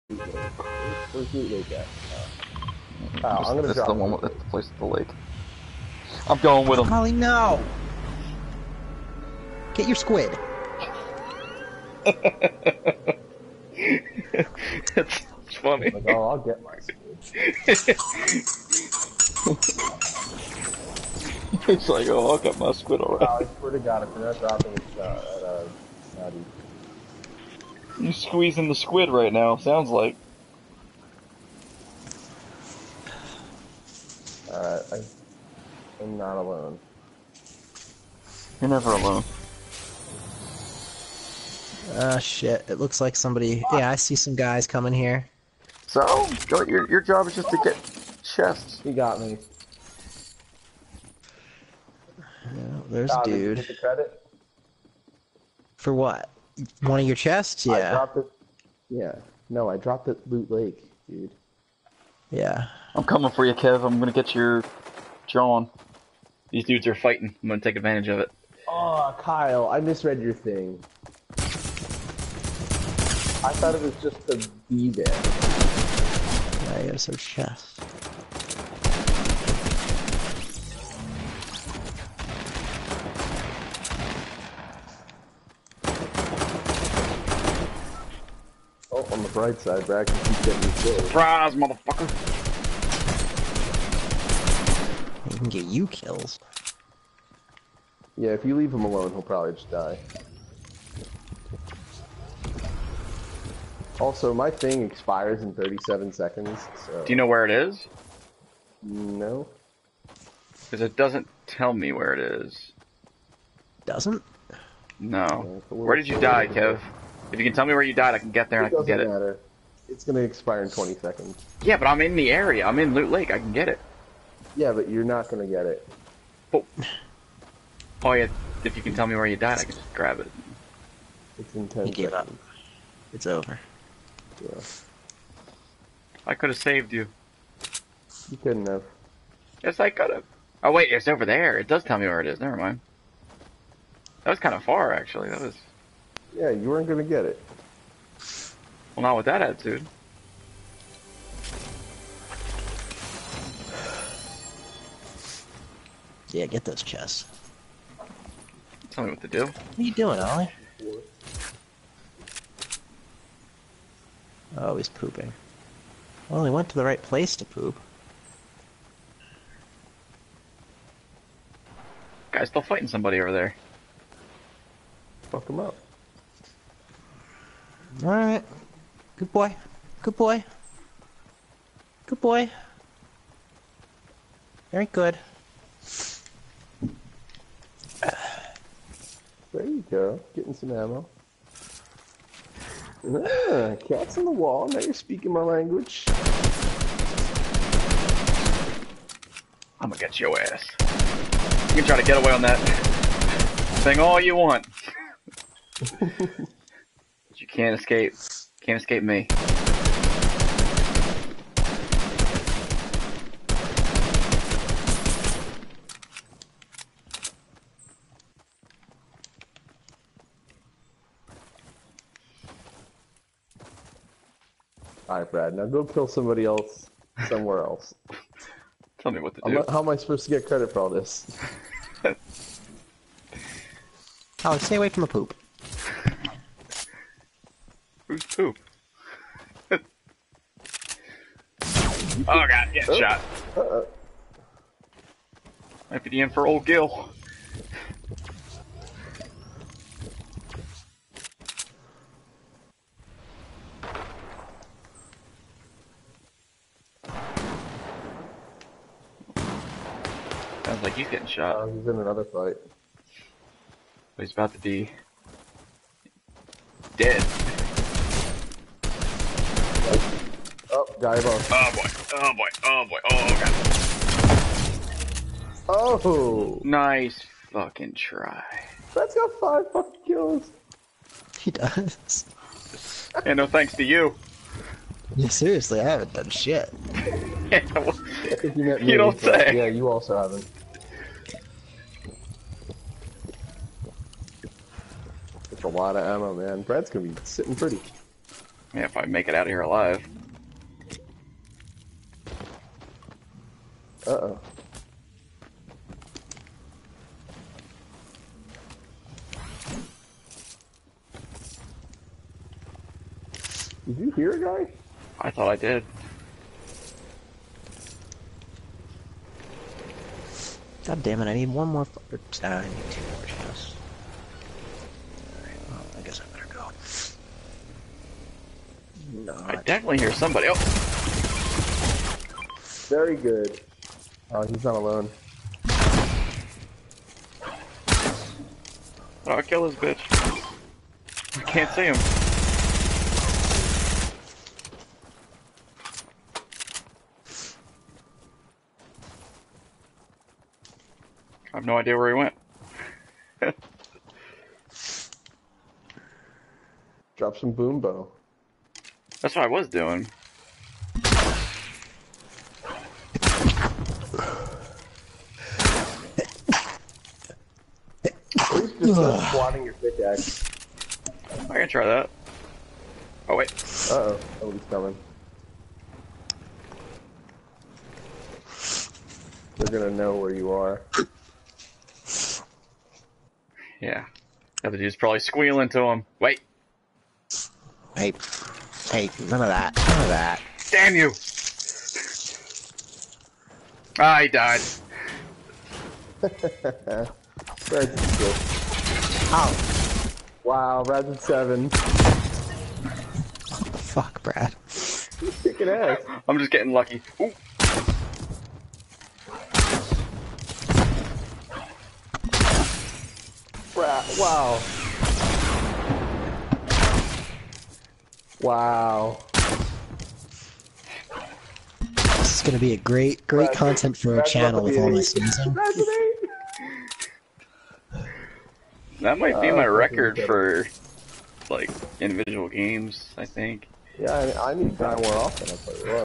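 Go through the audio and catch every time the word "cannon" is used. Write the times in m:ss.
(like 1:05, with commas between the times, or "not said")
not said.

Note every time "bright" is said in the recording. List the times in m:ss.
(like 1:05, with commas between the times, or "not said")
1:29.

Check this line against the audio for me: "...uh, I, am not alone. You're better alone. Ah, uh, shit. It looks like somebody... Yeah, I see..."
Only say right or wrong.
wrong.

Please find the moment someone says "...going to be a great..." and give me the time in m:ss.
7:02.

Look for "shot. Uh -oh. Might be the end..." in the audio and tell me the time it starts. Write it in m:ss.
4:02.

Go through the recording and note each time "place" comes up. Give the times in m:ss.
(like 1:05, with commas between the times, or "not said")
0:04, 2:47.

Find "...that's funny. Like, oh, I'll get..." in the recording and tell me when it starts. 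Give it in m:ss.
0:14.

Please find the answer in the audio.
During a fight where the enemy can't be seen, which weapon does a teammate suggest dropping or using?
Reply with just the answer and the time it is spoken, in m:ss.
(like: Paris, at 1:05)
boom bow, at 5:57.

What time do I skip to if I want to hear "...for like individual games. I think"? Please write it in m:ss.
7:10.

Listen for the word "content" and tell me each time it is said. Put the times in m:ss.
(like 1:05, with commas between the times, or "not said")
7:03.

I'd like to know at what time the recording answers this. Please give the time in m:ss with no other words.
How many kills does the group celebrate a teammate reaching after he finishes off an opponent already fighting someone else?
4:39.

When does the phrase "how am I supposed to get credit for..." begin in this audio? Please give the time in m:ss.
3:49.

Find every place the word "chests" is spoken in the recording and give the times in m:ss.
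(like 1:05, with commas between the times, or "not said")
0:48, 0:57, 1:17, 2:36, 5:23.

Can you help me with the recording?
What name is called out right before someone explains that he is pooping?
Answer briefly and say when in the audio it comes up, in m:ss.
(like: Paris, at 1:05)
Ollie, at 2:40.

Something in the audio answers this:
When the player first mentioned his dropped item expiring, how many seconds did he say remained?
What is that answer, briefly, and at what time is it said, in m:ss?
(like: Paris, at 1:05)
37, at 1:45.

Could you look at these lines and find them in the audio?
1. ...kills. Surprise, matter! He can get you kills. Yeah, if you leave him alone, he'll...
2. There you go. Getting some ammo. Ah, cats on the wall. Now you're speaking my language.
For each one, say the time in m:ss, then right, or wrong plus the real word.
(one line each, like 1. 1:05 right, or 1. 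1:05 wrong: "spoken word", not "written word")
1. 1:30 wrong: "motherfucker", not "matter"
2. 3:09 right.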